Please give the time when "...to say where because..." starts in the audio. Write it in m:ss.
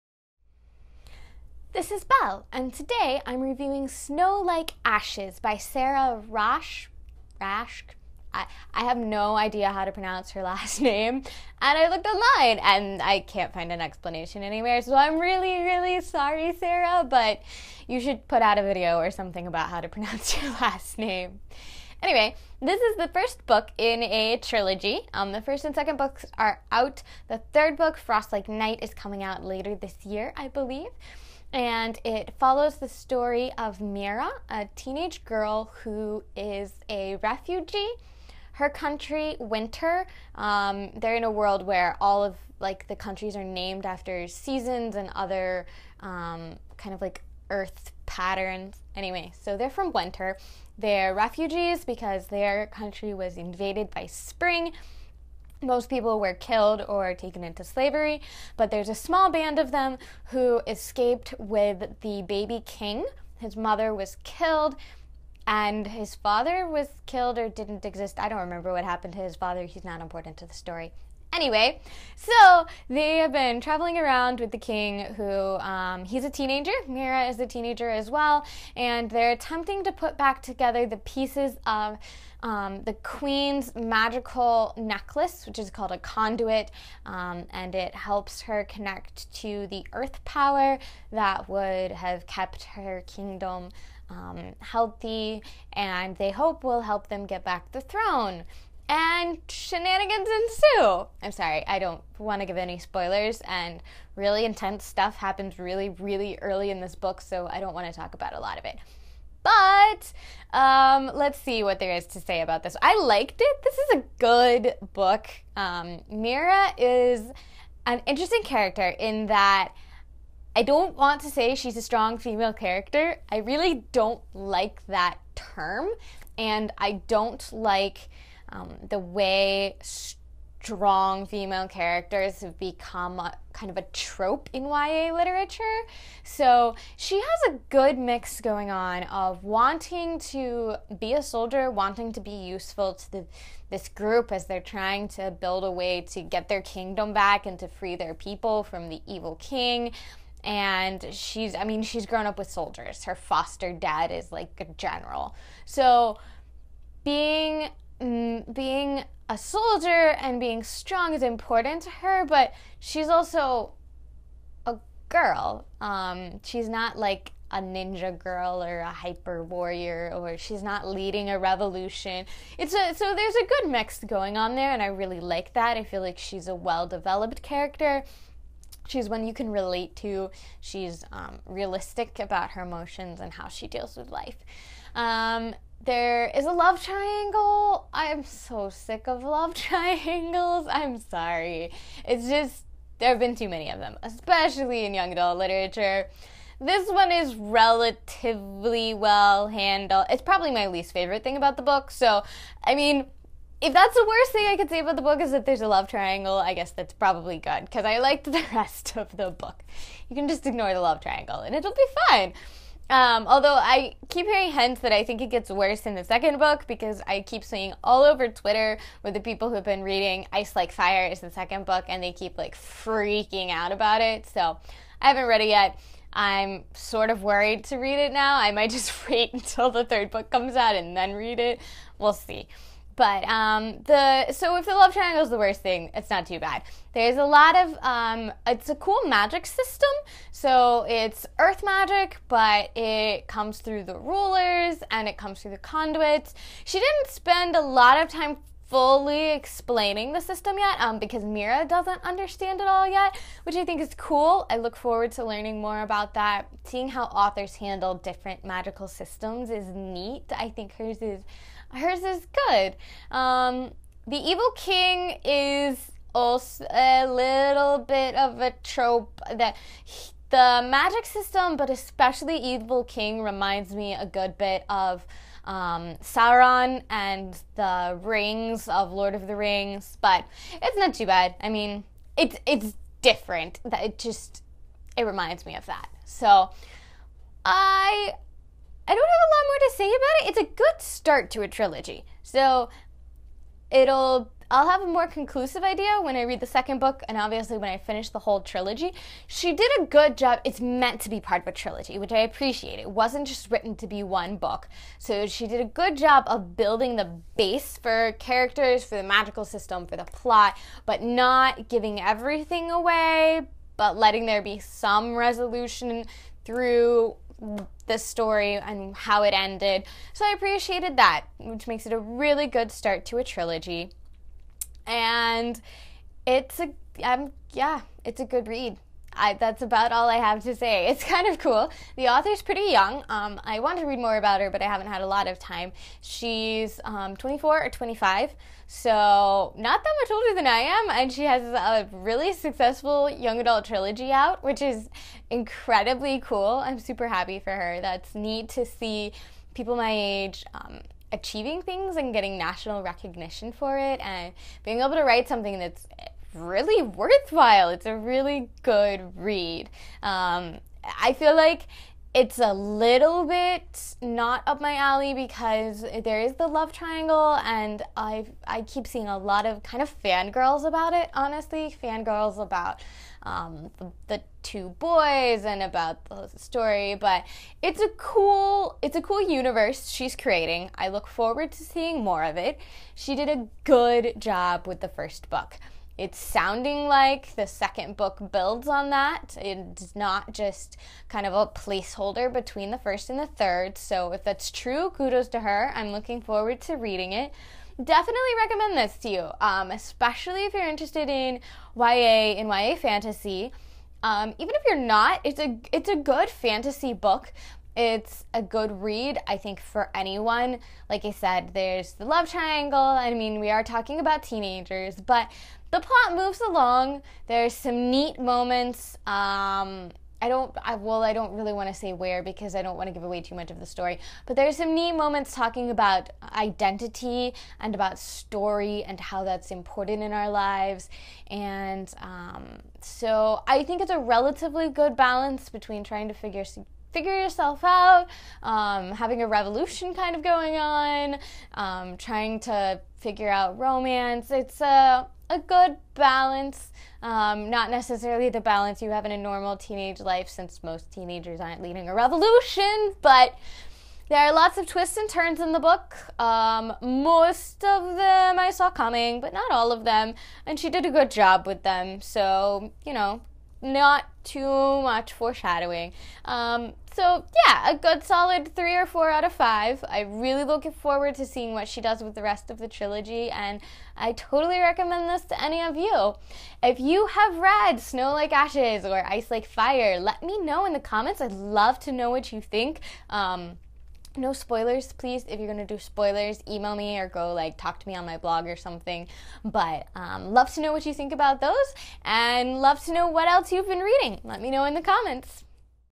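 7:01.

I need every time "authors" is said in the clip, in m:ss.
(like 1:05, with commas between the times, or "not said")
4:17, 5:32.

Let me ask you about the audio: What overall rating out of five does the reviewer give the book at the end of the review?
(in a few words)
3 or 4.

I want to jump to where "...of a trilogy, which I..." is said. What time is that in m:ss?
5:01.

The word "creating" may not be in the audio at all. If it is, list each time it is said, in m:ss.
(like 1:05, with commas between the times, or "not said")
6:20.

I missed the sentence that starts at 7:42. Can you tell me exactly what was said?
So, you know, not too much foreshadowing.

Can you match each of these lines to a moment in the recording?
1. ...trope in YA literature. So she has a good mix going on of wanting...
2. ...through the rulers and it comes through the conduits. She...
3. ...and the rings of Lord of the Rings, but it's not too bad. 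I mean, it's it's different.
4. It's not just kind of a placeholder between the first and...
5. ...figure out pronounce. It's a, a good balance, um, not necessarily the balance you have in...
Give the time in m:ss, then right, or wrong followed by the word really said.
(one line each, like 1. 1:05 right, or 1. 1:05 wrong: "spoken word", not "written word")
1. 2:13 right
2. 4:03 right
3. 4:36 right
4. 6:29 right
5. 7:22 wrong: "romance", not "pronounce".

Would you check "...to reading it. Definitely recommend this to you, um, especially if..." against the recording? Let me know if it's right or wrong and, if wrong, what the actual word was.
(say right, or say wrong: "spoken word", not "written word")
right.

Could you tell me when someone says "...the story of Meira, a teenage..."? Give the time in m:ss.
0:32.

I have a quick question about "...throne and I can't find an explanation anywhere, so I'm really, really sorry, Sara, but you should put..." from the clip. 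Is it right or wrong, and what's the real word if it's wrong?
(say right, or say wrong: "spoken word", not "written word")
wrong: "online", not "throne".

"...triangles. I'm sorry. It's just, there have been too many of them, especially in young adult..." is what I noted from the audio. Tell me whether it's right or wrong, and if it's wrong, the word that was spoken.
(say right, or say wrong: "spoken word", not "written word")
right.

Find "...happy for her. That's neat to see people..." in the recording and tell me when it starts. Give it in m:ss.
5:47.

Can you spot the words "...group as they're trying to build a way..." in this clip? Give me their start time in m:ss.
2:23.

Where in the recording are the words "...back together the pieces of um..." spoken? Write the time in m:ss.
1:20.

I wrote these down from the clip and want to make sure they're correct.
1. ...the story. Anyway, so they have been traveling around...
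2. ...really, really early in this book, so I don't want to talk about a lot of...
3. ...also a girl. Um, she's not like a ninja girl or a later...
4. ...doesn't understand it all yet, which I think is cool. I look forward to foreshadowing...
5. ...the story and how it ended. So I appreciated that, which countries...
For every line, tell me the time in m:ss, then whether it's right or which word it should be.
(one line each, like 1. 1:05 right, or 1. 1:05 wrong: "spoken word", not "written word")
1. 1:10 right
2. 1:45 right
3. 2:43 wrong: "hyper", not "later"
4. 4:11 wrong: "learning", not "foreshadowing"
5. 5:17 wrong: "makes", not "countries".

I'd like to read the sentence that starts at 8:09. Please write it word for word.
But um, love to know what you think about those and love to know what else you've been reading.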